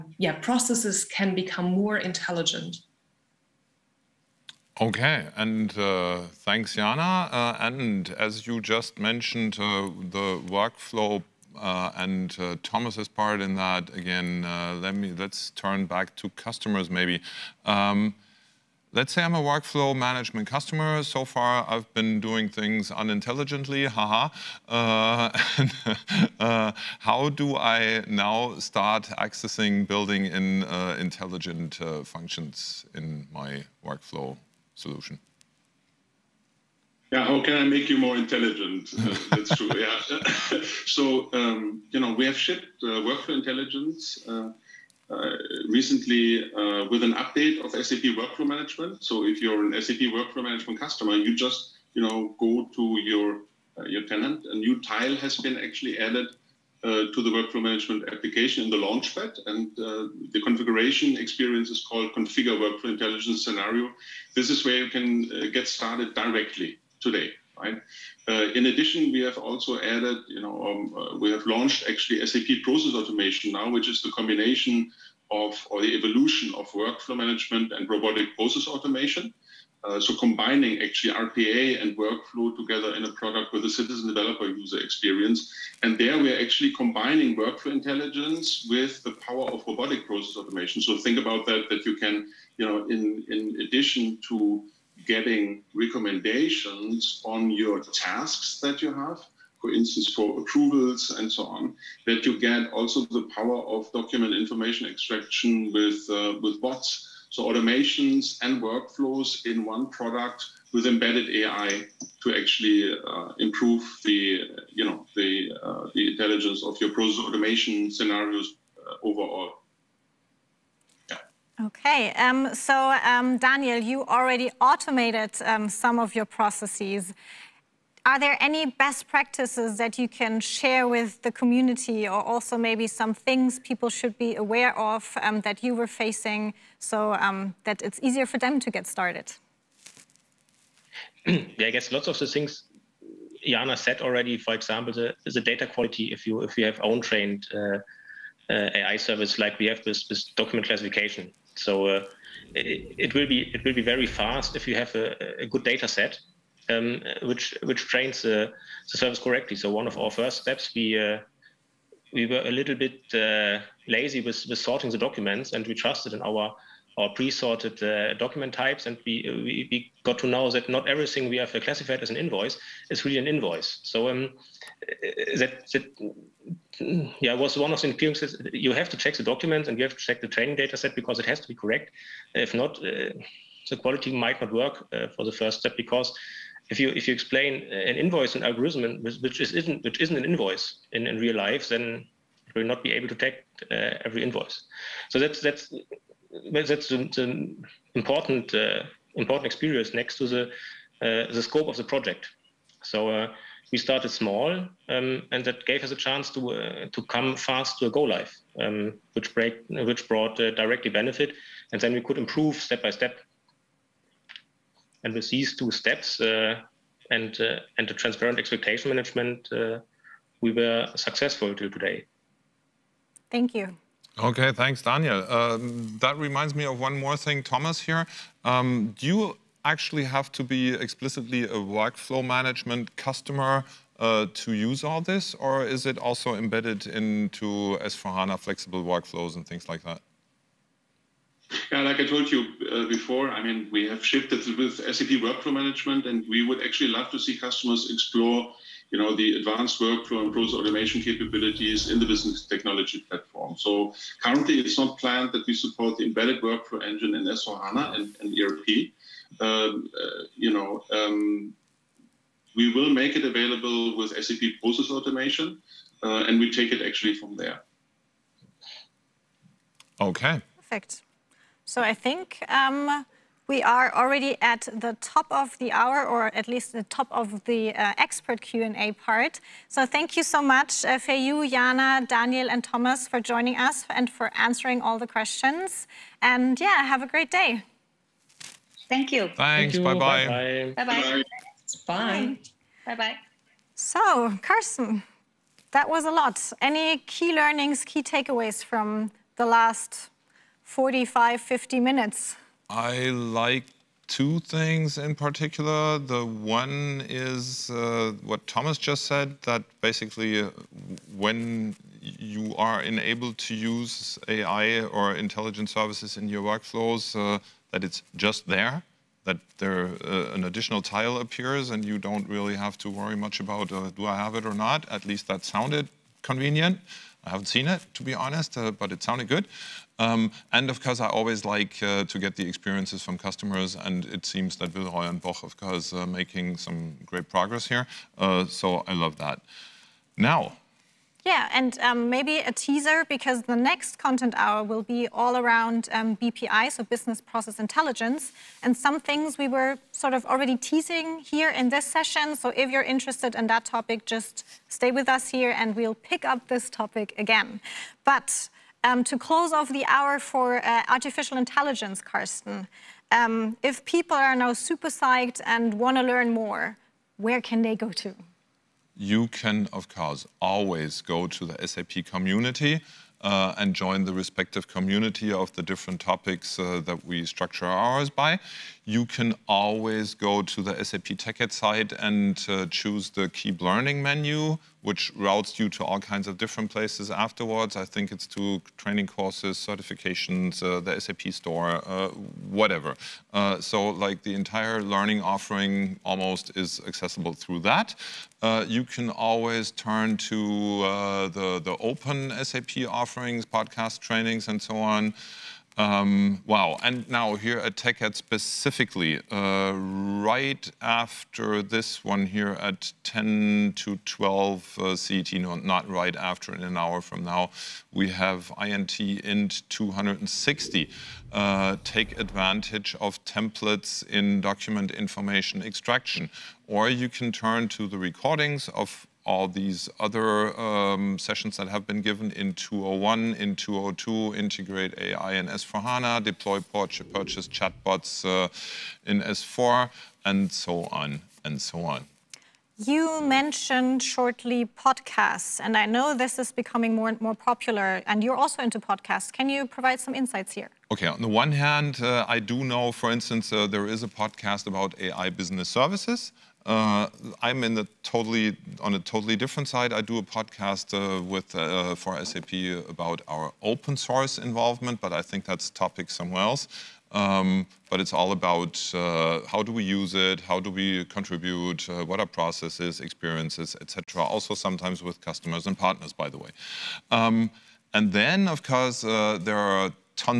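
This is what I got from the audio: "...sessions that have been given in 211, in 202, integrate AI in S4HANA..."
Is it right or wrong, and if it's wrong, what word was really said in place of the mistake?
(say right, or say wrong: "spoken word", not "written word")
wrong: "201", not "211".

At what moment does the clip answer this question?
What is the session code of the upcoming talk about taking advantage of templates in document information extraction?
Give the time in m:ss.
6:59.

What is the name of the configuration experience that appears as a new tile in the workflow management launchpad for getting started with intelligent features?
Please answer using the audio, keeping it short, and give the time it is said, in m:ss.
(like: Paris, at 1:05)
Configure Workflow Intelligence Scenario, at 1:02.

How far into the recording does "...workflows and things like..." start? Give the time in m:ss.
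3:58.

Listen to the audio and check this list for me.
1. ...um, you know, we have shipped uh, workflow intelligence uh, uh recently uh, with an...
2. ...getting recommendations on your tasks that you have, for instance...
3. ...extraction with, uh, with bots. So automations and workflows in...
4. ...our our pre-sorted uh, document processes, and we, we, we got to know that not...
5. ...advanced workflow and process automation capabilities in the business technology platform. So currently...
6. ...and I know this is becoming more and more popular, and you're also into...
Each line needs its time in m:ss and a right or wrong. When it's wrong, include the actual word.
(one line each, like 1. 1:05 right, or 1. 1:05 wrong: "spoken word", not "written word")
1. 0:41 right
2. 1:35 right
3. 1:44 right
4. 2:46 wrong: "types", not "processes"
5. 4:09 right
6. 7:25 right.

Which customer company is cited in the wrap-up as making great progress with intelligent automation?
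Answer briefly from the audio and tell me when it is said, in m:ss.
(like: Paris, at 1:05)
Villeroy and Boch, at 5:34.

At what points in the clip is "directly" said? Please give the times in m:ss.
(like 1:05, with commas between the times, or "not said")
1:06, 3:30.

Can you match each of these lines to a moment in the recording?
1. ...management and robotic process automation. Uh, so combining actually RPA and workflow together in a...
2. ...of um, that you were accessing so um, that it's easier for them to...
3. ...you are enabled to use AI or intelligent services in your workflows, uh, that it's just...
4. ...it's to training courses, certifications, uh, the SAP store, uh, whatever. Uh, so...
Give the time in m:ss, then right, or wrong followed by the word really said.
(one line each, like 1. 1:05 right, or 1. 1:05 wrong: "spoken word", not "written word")
1. 1:17 right
2. 2:14 wrong: "facing", not "accessing"
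3. 5:12 right
4. 6:28 right.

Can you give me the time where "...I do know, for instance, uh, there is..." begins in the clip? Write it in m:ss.
7:32.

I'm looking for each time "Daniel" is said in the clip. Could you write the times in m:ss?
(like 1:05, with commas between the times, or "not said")
2:03, 3:44, 4:42.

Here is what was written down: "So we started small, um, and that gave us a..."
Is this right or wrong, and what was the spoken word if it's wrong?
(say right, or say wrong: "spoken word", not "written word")
right.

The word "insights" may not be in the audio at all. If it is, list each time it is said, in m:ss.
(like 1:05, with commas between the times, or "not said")
7:30.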